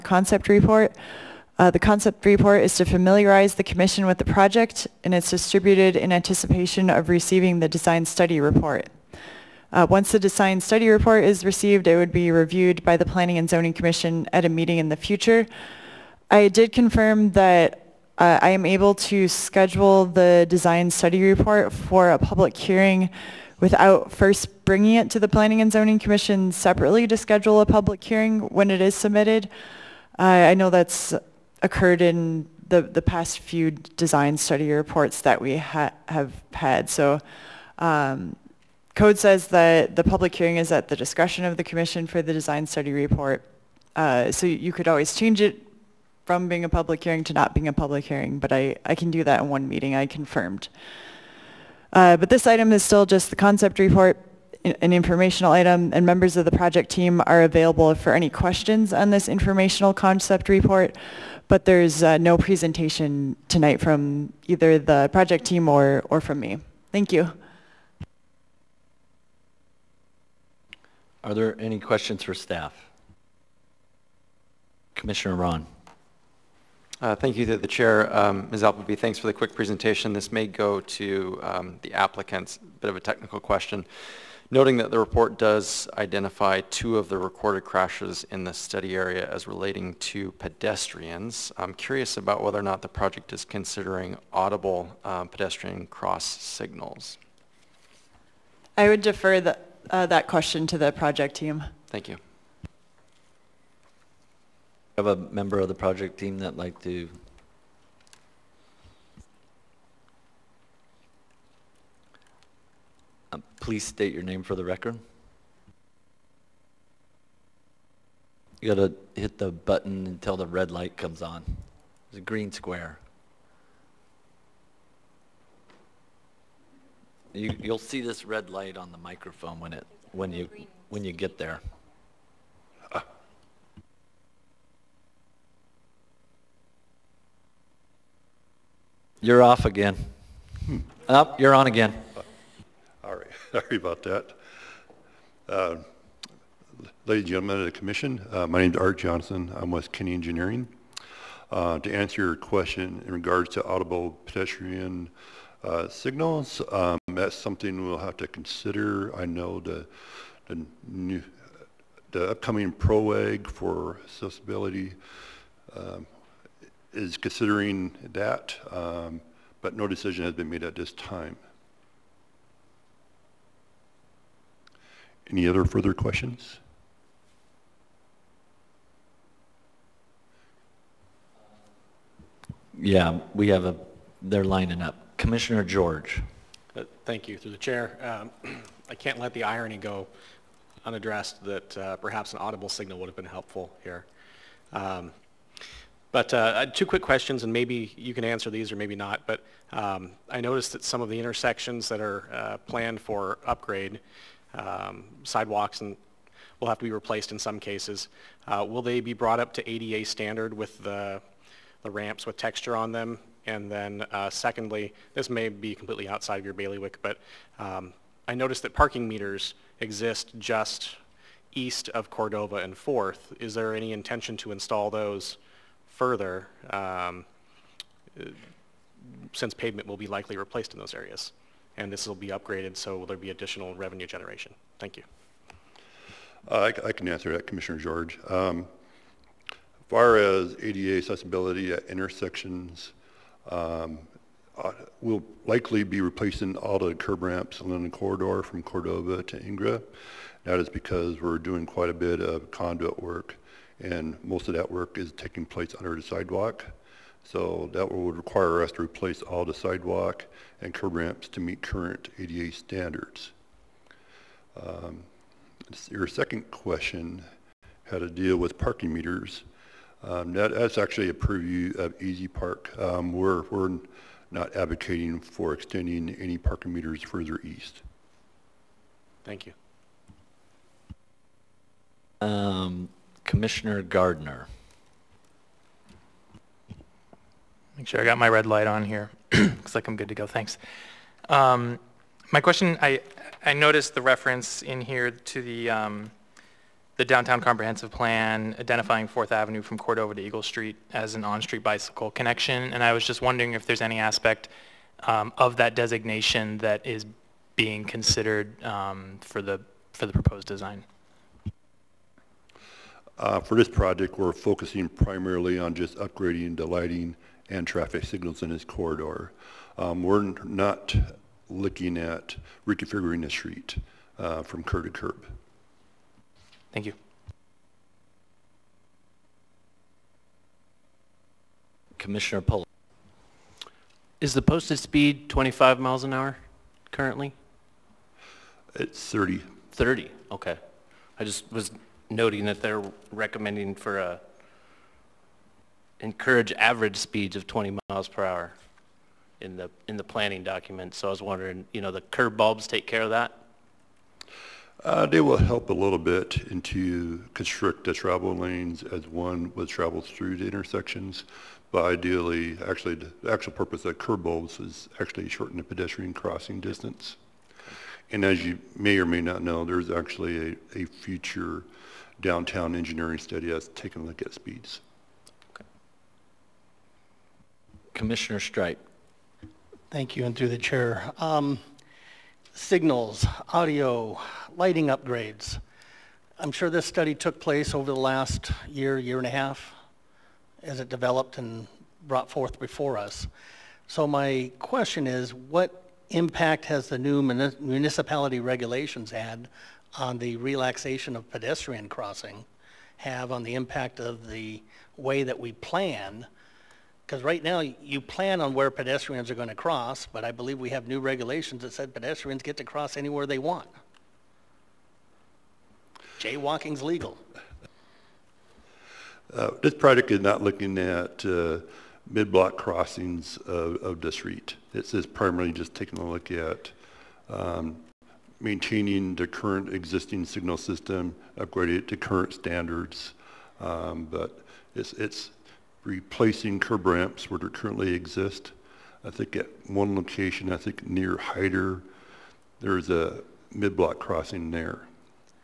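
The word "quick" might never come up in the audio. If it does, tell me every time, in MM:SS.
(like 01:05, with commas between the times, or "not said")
01:19, 03:16.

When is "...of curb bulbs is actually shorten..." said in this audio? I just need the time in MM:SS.
06:03.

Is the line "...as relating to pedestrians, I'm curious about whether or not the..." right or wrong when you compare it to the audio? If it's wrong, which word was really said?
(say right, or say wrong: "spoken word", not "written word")
right.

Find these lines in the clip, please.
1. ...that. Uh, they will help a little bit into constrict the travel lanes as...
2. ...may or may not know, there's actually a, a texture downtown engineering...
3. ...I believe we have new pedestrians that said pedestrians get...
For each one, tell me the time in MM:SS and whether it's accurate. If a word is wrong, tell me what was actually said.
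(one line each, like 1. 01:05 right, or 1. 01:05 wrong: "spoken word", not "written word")
1. 05:53 right
2. 06:08 wrong: "future", not "texture"
3. 06:50 wrong: "regulations", not "pedestrians".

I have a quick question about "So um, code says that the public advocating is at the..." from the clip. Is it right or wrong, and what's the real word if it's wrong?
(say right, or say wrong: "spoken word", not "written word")
wrong: "hearing", not "advocating".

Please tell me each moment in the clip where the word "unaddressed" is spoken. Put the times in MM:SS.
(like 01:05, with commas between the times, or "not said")
03:10.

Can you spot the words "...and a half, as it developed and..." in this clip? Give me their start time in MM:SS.
06:29.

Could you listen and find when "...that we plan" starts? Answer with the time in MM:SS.
06:45.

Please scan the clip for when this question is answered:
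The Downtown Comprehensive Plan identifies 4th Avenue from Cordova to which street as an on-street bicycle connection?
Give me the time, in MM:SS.
05:00.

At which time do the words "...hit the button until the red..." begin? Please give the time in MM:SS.
01:59.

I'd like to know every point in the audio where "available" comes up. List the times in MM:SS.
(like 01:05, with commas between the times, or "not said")
00:57.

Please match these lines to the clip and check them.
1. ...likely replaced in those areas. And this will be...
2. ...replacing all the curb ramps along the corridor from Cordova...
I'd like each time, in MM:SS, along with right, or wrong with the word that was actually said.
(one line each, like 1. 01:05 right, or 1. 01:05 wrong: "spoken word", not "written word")
1. 03:50 right
2. 04:06 right.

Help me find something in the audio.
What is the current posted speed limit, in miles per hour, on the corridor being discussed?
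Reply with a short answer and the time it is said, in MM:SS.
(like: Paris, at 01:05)
30, at 05:38.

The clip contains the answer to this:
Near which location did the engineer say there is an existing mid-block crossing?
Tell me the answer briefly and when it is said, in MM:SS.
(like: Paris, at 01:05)
Hyder, at 07:21.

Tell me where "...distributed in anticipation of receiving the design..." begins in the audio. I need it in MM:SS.
00:05.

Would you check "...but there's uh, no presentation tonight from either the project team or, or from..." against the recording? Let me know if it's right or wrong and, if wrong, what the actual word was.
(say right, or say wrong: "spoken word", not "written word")
right.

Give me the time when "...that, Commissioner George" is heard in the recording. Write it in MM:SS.
03:57.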